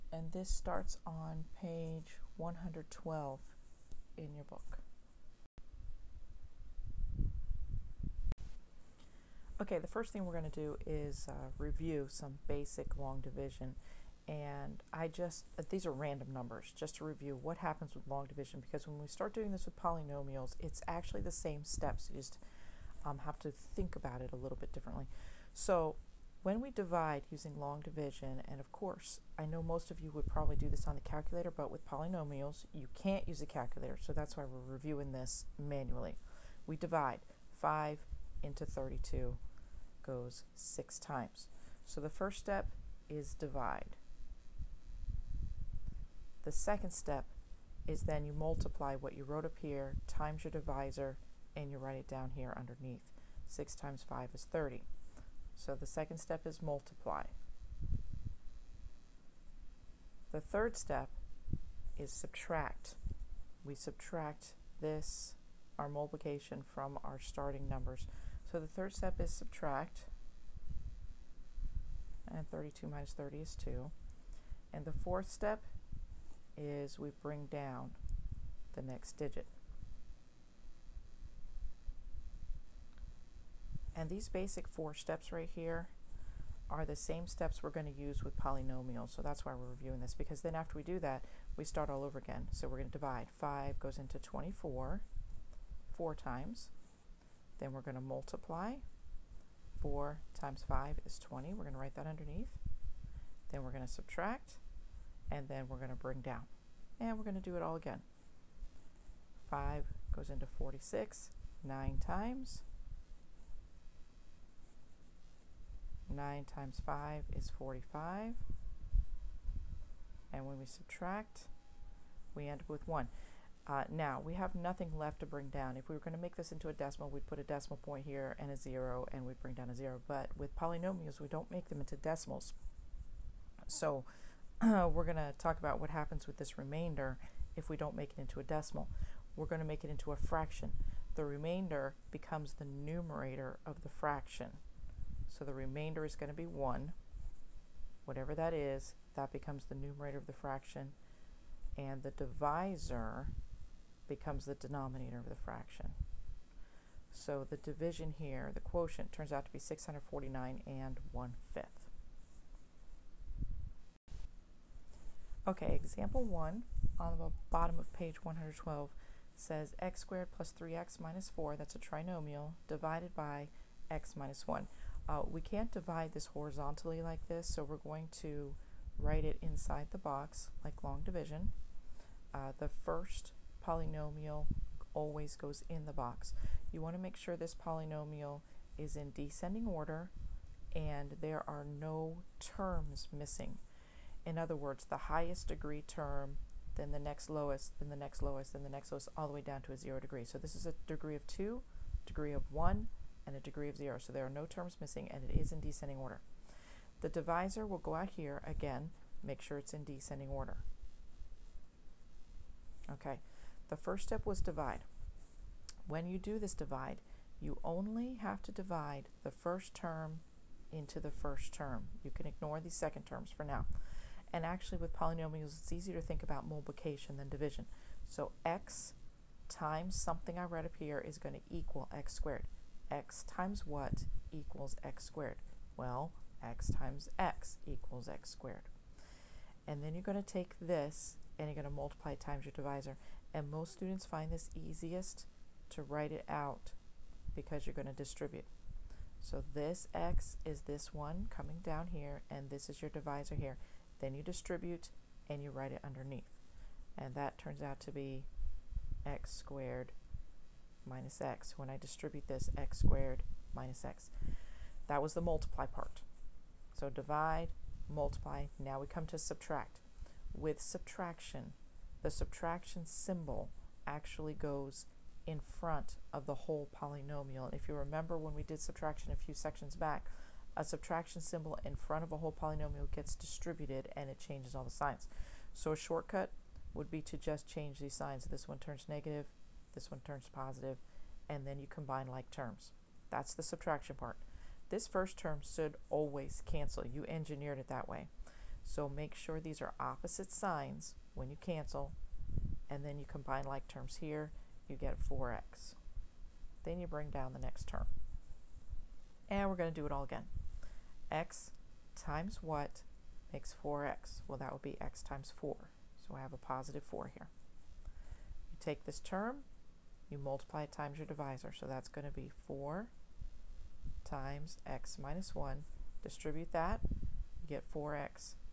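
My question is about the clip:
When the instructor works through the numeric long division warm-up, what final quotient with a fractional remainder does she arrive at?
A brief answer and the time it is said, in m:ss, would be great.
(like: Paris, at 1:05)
649 and 1/5, at 2:39.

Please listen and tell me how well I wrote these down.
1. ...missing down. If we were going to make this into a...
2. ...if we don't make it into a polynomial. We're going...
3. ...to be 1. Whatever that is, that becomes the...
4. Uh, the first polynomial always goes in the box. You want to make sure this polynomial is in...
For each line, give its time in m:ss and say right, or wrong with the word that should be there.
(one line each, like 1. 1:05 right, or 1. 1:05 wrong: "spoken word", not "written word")
1. 2:05 wrong: "bring", not "missing"
2. 2:17 wrong: "decimal", not "polynomial"
3. 2:26 right
4. 3:02 right.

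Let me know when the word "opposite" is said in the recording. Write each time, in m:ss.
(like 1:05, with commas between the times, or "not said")
4:59.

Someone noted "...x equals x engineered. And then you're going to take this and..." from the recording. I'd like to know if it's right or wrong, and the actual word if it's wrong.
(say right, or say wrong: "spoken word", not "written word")
wrong: "squared", not "engineered".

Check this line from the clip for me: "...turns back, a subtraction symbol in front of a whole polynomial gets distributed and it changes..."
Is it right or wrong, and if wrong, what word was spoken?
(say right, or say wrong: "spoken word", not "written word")
wrong: "sections", not "turns".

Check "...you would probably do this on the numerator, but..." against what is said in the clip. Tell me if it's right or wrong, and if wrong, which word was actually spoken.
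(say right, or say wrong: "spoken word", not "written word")
wrong: "calculator", not "numerator".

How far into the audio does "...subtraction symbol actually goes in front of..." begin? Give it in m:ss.
4:32.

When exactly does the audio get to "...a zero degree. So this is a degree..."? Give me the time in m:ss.
3:19.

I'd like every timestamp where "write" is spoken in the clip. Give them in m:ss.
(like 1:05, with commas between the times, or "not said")
0:51, 1:41, 2:58, 4:05, 4:15.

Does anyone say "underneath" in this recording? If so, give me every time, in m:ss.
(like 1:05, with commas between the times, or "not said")
0:52, 1:42, 4:15.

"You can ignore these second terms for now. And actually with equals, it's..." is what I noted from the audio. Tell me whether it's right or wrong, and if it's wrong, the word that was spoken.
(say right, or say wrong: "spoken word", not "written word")
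wrong: "polynomials", not "equals".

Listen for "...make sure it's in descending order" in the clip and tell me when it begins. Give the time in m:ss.
3:29.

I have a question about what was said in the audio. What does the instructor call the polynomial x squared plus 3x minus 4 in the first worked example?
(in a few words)
trinomial.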